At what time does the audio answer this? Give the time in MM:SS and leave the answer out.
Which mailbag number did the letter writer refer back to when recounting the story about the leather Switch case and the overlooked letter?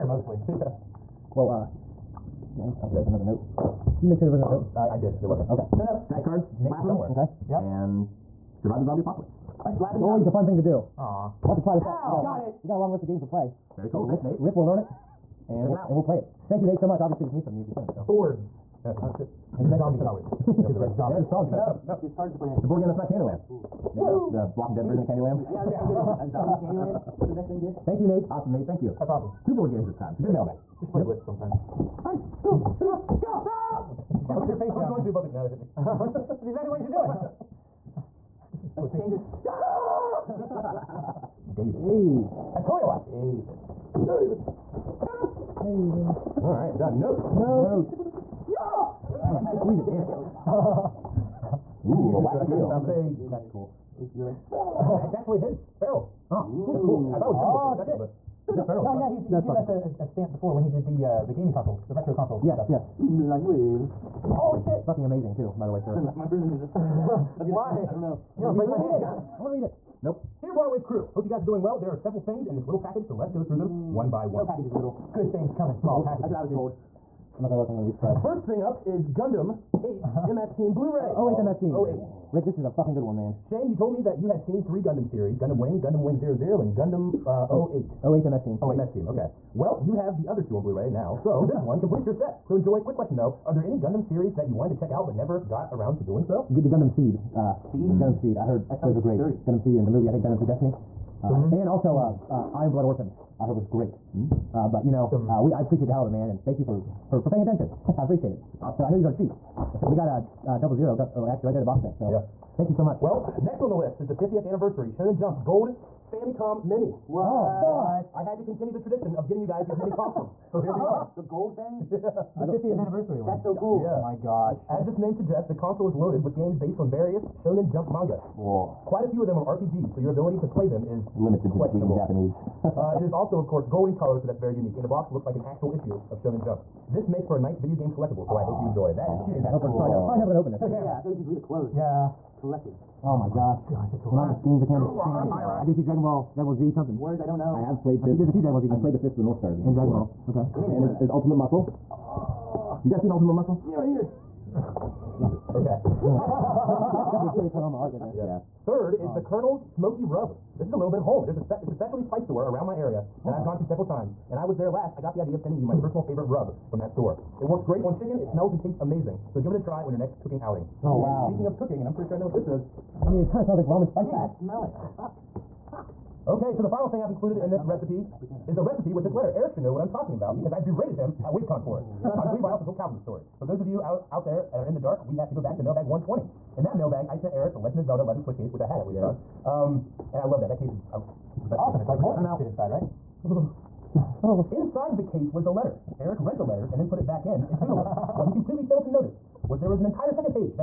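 03:05.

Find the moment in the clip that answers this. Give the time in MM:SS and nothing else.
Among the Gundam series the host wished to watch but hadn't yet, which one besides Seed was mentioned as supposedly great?
01:42.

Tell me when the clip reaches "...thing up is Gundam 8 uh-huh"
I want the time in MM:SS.
01:18.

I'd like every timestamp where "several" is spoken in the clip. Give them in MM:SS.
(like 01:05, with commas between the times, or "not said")
01:11, 02:43.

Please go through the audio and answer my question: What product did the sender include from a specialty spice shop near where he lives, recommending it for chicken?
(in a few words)
Colonel's Smoky Rub.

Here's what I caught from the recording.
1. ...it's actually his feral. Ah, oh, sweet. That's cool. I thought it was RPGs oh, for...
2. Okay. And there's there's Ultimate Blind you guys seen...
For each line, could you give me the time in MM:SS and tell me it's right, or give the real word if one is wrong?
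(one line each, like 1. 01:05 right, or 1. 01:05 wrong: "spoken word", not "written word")
1. 00:55 wrong: "Gryffindor", not "RPGs"
2. 02:30 wrong: "Muscle", not "Blind".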